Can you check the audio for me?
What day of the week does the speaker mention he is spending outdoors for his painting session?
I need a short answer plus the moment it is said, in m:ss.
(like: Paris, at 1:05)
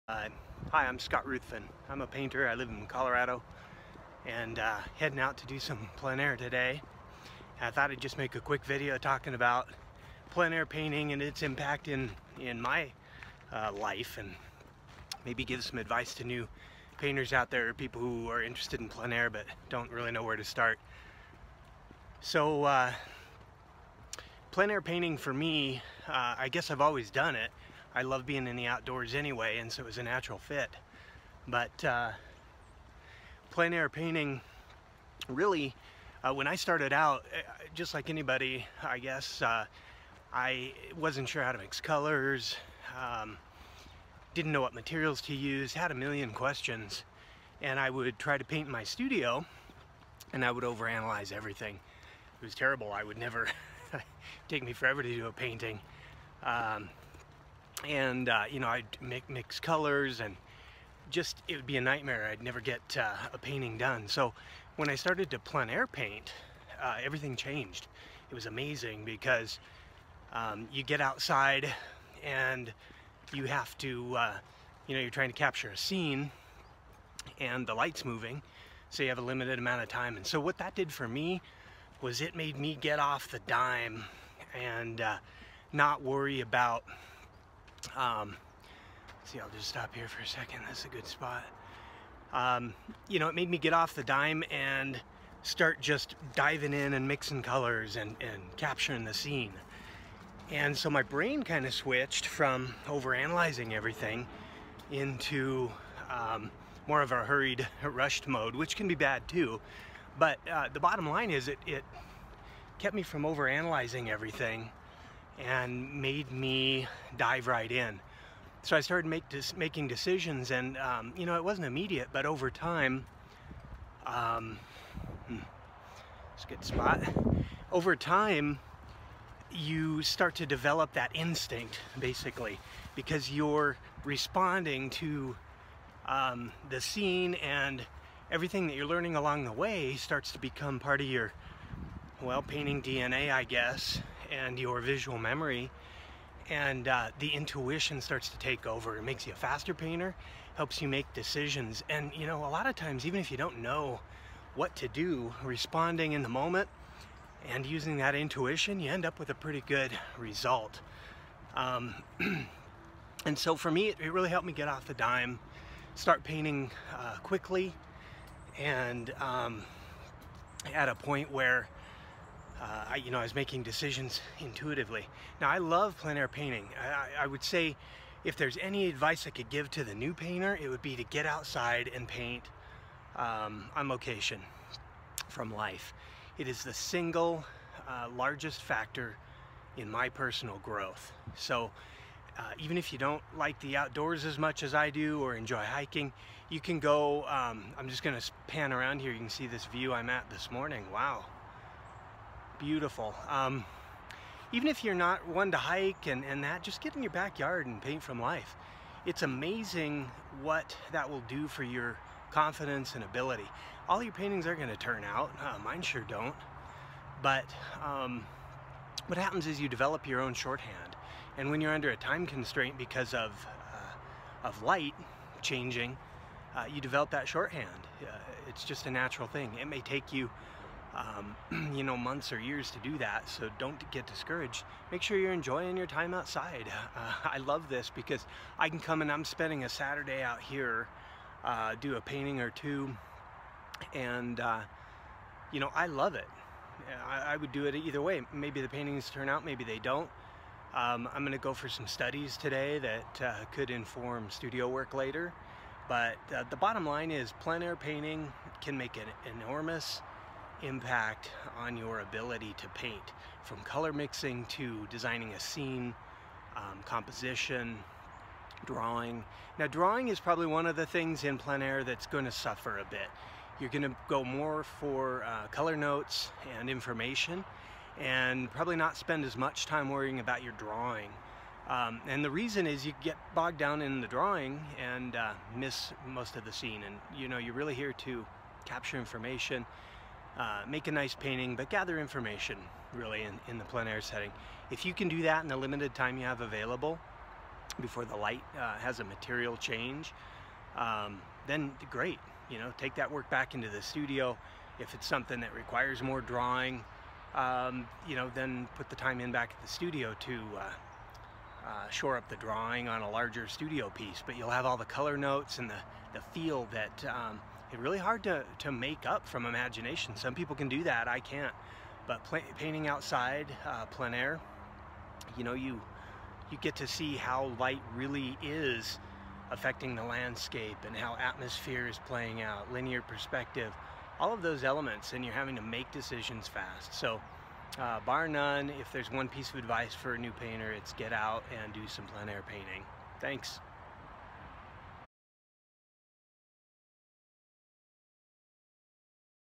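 Saturday, at 3:59.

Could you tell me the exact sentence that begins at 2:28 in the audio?
It makes you a faster painter, helps you make decisions.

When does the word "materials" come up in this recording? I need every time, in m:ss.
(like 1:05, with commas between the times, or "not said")
0:44, 4:59.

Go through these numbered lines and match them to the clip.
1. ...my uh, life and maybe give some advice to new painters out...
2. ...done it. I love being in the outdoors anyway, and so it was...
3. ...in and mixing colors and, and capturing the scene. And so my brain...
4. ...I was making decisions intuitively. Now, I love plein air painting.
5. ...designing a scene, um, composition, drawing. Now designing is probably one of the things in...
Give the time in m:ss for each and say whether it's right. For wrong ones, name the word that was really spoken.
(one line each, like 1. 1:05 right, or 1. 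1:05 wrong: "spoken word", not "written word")
1. 0:12 right
2. 0:27 right
3. 1:36 right
4. 2:53 right
5. 4:24 wrong: "drawing", not "designing".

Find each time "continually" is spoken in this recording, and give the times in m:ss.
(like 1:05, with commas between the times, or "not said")
not said.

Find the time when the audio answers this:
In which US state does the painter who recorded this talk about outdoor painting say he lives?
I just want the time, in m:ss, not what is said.
0:02.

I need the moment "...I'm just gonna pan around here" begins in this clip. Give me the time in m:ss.
3:17.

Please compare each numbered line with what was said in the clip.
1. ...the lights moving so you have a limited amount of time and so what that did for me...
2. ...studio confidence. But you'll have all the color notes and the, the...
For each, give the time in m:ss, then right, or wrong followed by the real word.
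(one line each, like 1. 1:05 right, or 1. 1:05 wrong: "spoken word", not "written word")
1. 1:17 right
2. 5:13 wrong: "piece", not "confidence".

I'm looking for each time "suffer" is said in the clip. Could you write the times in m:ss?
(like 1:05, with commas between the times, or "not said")
4:32.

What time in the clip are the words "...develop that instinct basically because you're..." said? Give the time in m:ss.
2:10.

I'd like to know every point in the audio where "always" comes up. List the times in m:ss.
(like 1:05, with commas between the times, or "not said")
0:26.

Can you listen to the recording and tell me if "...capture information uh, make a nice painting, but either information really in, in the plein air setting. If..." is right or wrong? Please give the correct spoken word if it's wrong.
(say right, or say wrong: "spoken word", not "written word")
wrong: "gather", not "either".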